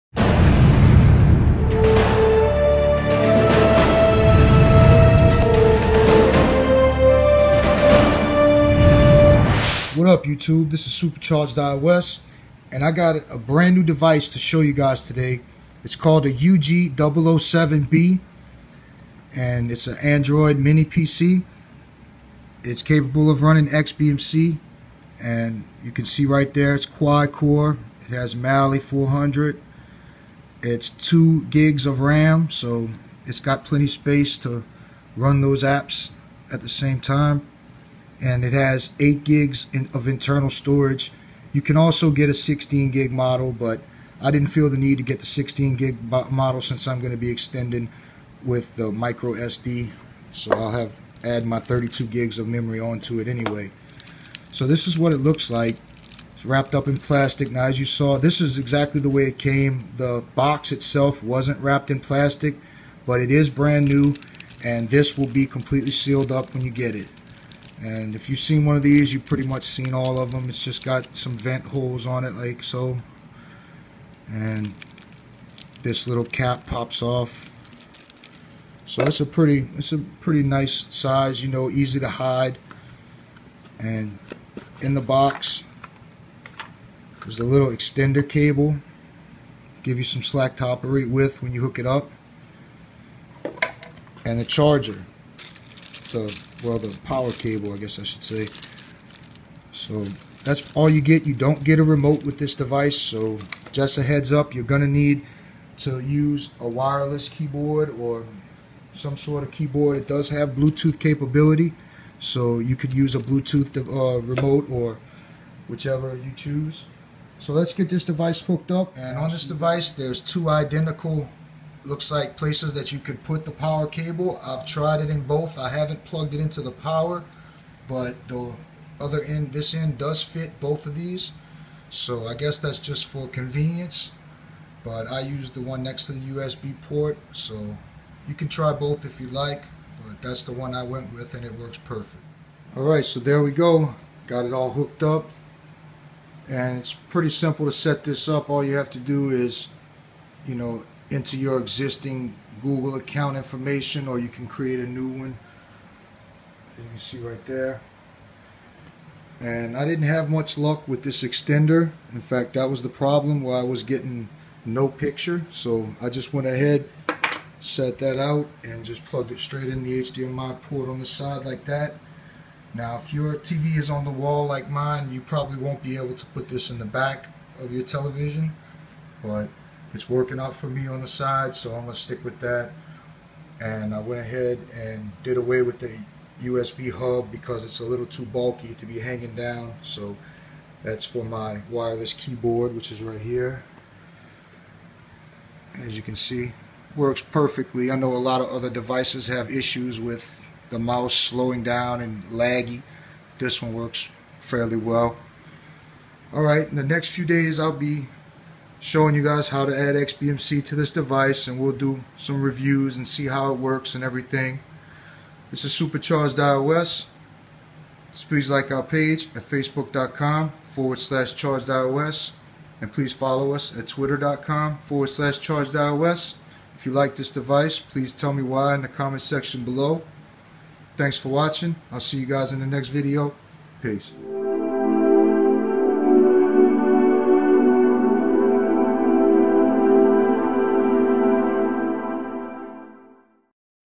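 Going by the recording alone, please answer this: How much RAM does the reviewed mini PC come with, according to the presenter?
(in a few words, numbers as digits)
2 GB.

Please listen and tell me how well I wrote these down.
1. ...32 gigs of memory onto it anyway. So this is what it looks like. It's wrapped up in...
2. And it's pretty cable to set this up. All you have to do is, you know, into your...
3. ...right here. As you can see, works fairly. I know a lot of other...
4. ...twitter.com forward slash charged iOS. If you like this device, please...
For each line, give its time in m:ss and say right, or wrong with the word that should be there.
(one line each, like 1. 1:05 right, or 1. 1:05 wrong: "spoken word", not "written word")
1. 0:51 right
2. 2:26 wrong: "simple", not "cable"
3. 3:13 wrong: "perfectly", not "fairly"
4. 3:43 right.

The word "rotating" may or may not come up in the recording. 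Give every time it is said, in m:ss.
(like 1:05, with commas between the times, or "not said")
not said.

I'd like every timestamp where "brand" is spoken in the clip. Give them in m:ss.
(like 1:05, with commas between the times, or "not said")
0:13, 1:03.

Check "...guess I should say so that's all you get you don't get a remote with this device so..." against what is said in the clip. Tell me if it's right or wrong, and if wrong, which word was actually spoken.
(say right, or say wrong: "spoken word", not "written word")
right.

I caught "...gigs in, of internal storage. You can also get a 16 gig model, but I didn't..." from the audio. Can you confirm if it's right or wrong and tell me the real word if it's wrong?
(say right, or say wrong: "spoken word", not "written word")
right.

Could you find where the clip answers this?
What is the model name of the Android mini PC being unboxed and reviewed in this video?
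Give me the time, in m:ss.
0:16.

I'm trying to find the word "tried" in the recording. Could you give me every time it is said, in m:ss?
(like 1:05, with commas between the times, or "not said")
2:04.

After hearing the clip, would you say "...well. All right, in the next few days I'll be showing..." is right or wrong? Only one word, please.
right.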